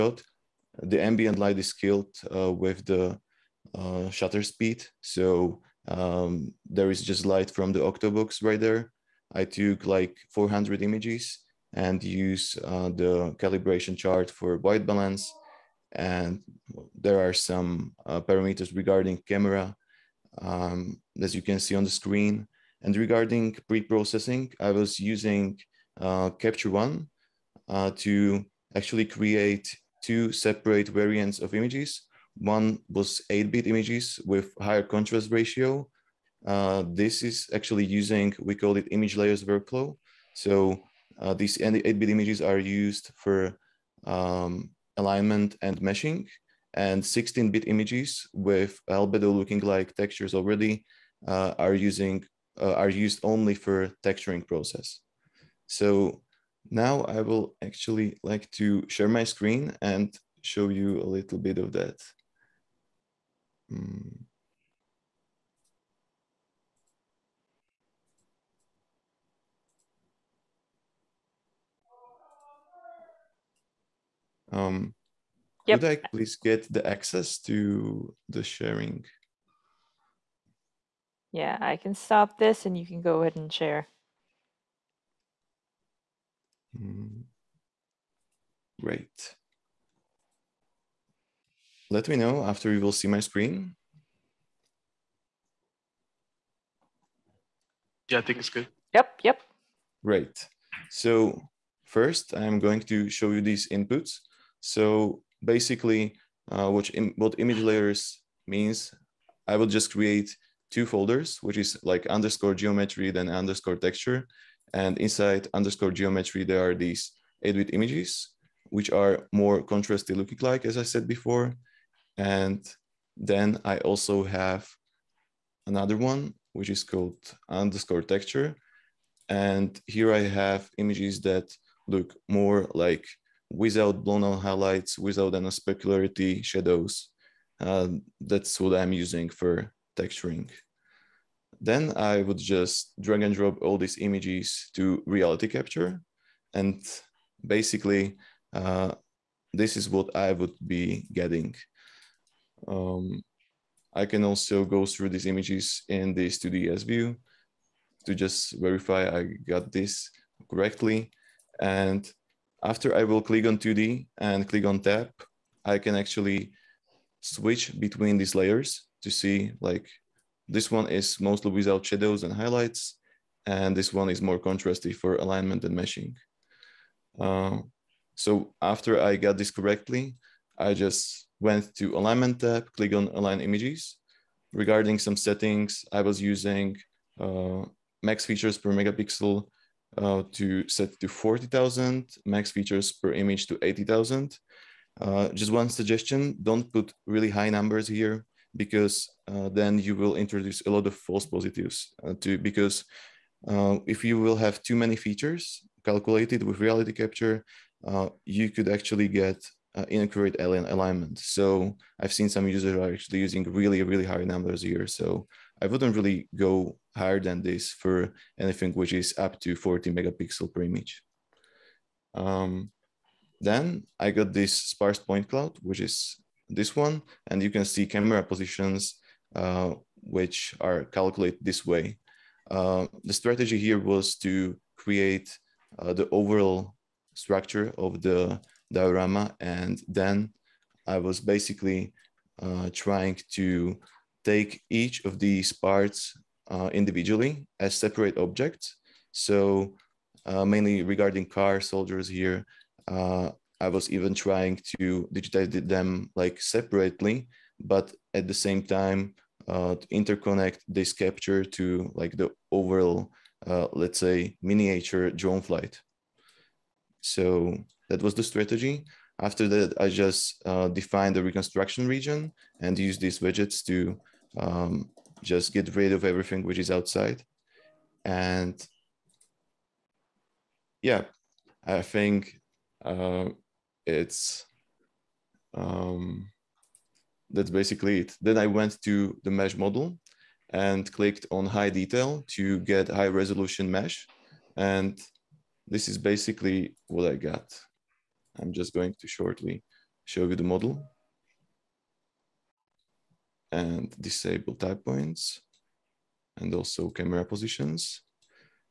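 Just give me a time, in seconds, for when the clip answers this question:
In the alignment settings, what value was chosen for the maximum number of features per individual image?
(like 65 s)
193 s.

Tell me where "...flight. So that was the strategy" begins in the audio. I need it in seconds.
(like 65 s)
265 s.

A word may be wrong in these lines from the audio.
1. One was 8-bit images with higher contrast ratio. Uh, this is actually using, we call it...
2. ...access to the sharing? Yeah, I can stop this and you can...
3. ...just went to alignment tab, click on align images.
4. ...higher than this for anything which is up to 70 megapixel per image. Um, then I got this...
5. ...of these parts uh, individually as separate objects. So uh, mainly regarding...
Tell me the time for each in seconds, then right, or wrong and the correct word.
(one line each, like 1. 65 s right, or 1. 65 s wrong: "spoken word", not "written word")
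1. 32 s right
2. 76 s right
3. 180 s right
4. 216 s wrong: "40", not "70"
5. 245 s right.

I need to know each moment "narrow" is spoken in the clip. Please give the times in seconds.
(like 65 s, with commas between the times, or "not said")
not said.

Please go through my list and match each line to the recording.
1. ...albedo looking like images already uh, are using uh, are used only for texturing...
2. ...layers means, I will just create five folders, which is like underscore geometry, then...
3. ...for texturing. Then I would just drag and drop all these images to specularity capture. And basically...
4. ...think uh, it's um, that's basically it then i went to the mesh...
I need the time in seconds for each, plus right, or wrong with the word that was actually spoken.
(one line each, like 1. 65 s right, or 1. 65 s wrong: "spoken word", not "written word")
1. 48 s wrong: "textures", not "images"
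2. 107 s wrong: "two", not "five"
3. 139 s wrong: "reality", not "specularity"
4. 281 s right.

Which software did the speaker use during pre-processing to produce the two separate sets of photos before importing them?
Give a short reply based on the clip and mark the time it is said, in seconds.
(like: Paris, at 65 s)
Capture One, at 26 s.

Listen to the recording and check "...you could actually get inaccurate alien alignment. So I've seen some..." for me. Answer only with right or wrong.
right.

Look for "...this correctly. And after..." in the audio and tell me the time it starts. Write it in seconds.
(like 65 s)
159 s.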